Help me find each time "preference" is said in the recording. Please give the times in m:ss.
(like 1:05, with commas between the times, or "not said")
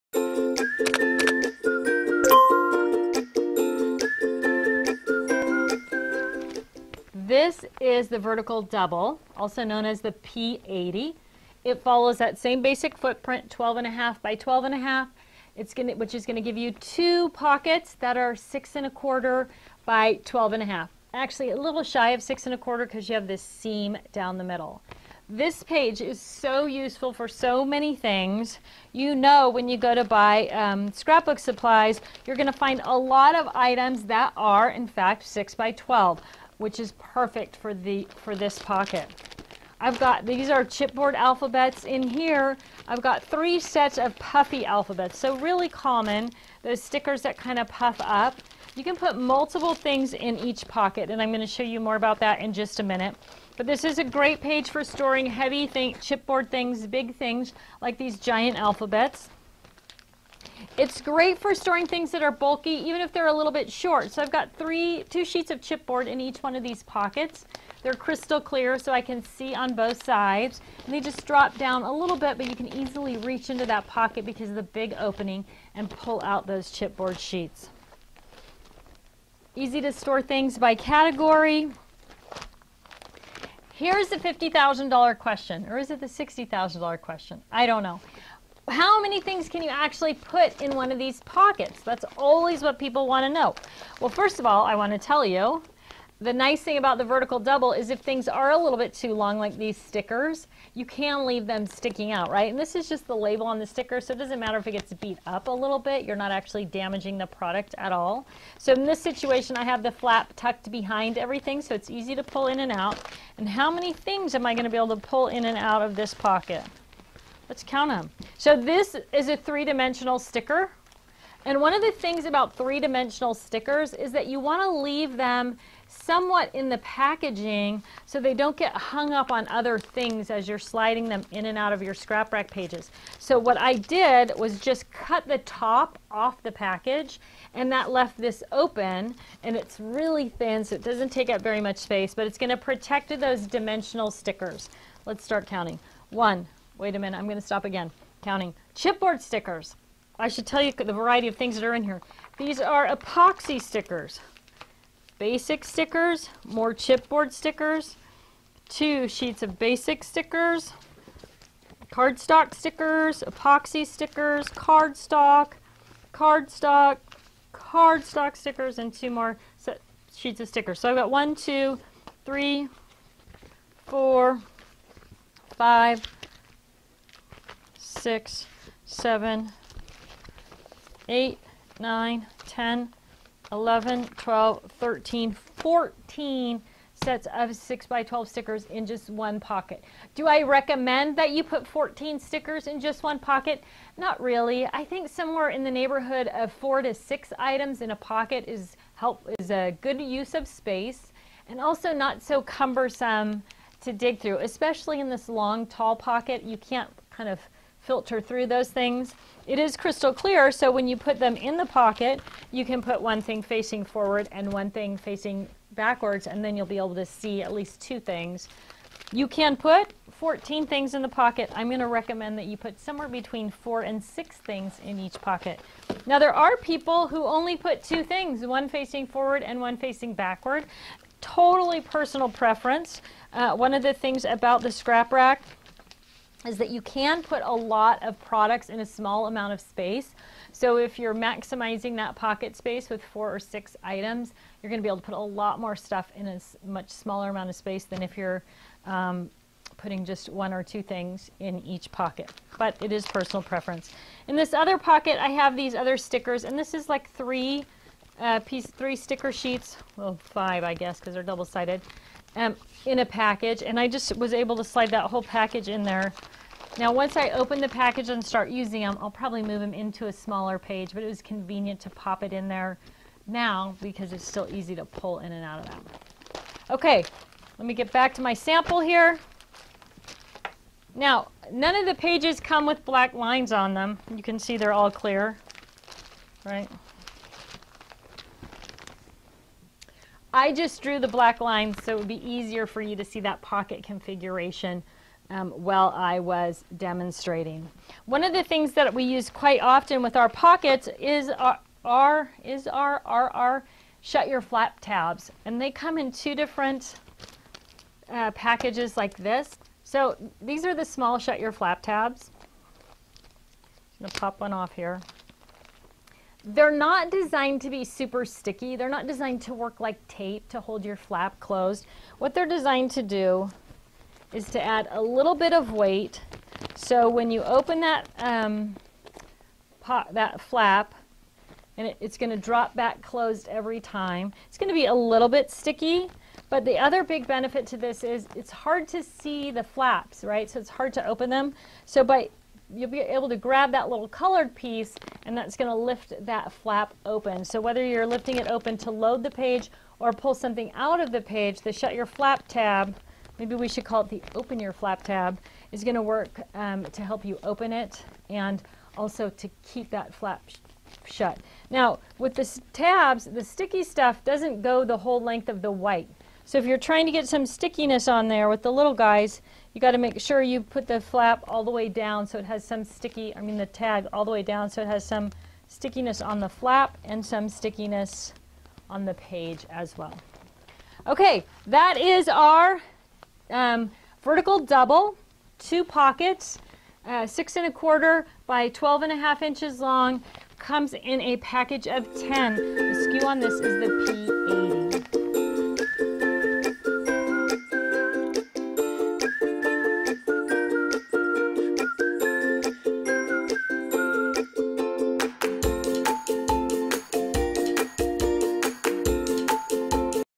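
3:52, 4:13.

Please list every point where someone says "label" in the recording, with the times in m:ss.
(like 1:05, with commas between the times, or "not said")
1:43.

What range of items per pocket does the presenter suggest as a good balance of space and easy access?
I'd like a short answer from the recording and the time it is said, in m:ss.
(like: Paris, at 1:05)
4 to 6, at 3:16.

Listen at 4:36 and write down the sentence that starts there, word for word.
Okay, let me get back to my sample here.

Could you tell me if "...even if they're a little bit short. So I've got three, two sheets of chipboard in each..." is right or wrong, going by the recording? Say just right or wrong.
right.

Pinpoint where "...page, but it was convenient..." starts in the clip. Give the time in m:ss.
4:30.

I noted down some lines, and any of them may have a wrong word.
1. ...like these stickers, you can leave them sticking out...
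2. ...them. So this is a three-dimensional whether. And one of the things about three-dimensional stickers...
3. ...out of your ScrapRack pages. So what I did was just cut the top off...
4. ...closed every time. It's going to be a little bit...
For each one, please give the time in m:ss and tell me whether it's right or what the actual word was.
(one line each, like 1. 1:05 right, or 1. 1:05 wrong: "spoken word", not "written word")
1. 1:39 right
2. 1:57 wrong: "sticker", not "whether"
3. 2:11 right
4. 5:33 right.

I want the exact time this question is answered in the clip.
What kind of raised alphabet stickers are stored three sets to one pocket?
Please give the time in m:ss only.
0:44.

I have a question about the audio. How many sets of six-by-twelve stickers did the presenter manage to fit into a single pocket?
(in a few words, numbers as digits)
14.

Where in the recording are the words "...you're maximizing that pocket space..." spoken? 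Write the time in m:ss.
4:00.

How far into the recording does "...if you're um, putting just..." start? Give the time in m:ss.
4:08.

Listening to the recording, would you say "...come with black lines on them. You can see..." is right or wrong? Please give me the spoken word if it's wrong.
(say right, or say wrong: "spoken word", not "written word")
right.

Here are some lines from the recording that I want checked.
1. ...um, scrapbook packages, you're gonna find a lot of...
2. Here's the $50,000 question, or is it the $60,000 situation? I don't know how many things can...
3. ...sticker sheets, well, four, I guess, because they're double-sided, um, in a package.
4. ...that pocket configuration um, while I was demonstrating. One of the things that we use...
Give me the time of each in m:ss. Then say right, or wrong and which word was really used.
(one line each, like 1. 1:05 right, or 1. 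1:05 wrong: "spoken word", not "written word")
1. 0:30 wrong: "supplies", not "packages"
2. 1:23 wrong: "question", not "situation"
3. 4:18 wrong: "five", not "four"
4. 4:53 right.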